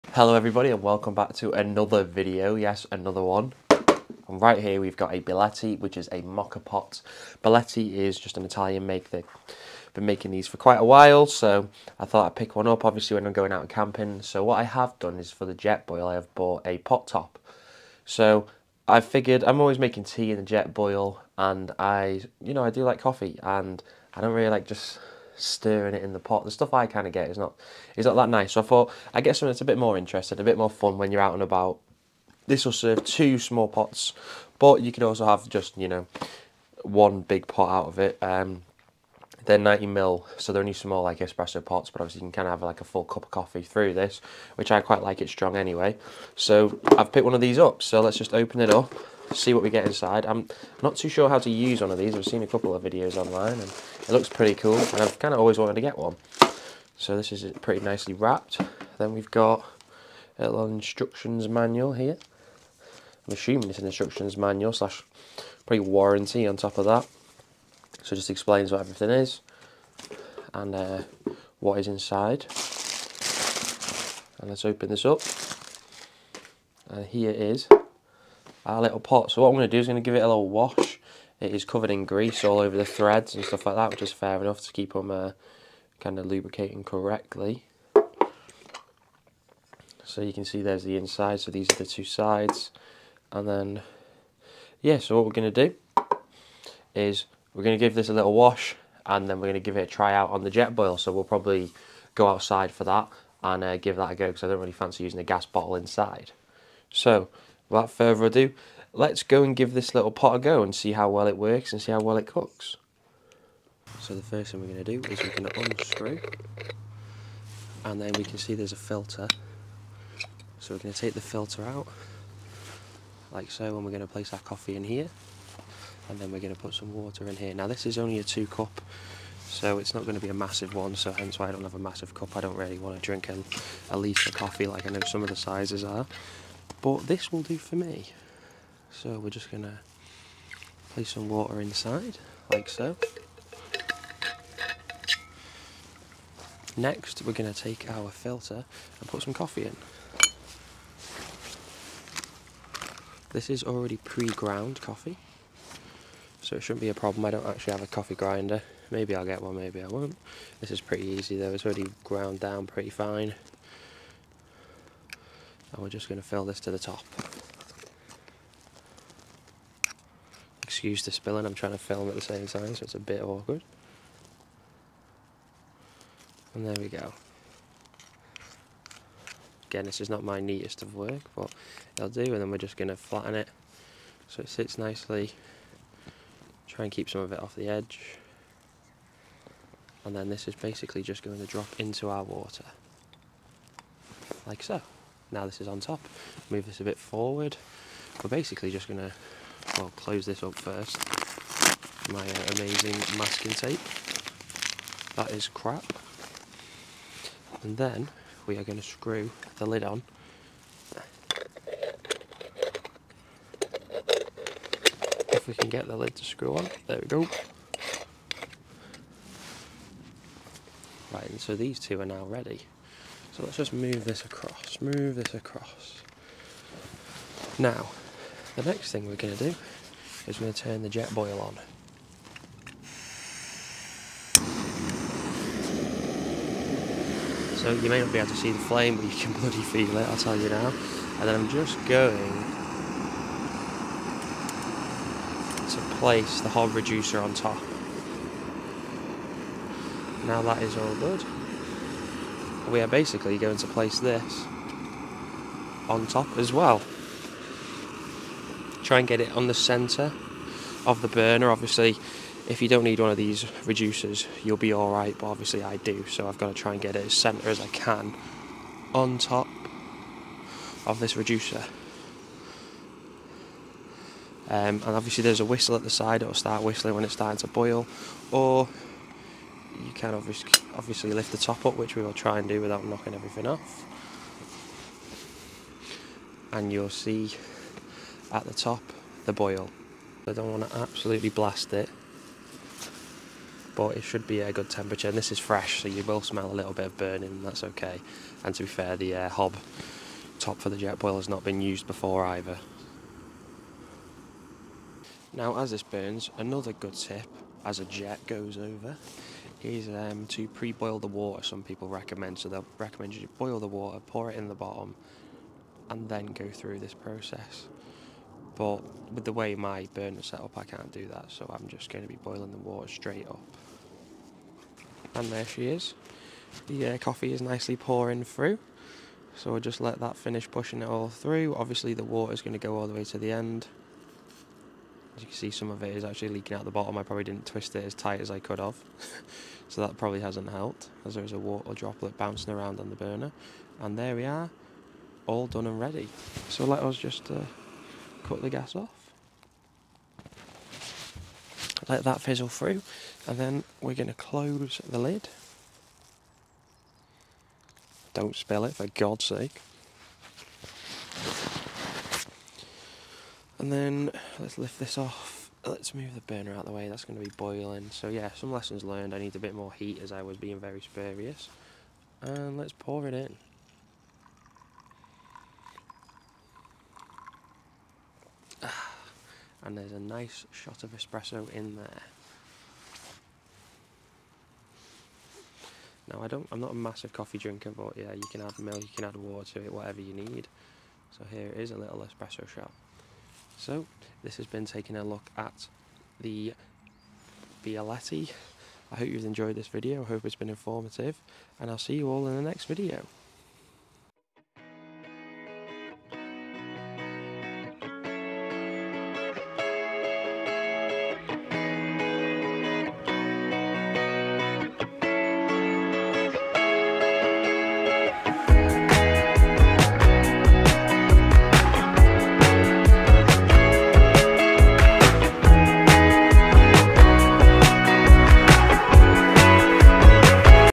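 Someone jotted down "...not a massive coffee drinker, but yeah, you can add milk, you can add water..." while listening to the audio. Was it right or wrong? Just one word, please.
right.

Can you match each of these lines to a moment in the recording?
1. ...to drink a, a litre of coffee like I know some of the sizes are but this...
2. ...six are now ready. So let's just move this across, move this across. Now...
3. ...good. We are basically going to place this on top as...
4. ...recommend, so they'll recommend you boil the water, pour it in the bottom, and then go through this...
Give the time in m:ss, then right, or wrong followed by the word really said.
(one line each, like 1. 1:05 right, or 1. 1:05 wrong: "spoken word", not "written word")
1. 2:12 right
2. 3:41 wrong: "two", not "six"
3. 4:10 right
4. 5:11 right.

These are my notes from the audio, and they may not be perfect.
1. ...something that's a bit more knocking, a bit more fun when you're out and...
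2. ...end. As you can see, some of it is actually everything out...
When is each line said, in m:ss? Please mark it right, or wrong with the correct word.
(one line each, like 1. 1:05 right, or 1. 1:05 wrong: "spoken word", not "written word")
1. 0:29 wrong: "interesting", not "knocking"
2. 5:33 wrong: "leaking", not "everything".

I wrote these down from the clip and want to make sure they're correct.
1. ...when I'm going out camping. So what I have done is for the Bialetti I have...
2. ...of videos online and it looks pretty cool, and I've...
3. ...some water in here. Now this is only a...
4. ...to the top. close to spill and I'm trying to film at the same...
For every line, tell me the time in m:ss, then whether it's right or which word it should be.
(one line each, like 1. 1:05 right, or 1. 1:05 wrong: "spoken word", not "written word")
1. 0:13 wrong: "Jetboil", not "Bialetti"
2. 0:52 right
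3. 2:06 right
4. 2:46 wrong: "excuse", not "close".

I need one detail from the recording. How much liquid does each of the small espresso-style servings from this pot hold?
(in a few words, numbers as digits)
90 ml.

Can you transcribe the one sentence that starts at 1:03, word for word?
I'm assuming it's an instructions manual slash probably warranty on top of that.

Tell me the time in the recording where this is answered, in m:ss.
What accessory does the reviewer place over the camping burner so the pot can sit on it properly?
4:06.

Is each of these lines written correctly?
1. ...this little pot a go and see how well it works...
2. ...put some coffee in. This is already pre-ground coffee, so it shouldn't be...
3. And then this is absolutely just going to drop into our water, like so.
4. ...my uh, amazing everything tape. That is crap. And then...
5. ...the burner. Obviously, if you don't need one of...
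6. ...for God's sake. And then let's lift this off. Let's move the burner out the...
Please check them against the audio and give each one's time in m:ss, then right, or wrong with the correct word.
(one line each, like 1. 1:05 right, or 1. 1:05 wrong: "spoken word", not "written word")
1. 1:49 right
2. 2:29 right
3. 3:10 wrong: "basically", not "absolutely"
4. 3:22 wrong: "masking", not "everything"
5. 4:21 right
6. 5:58 right.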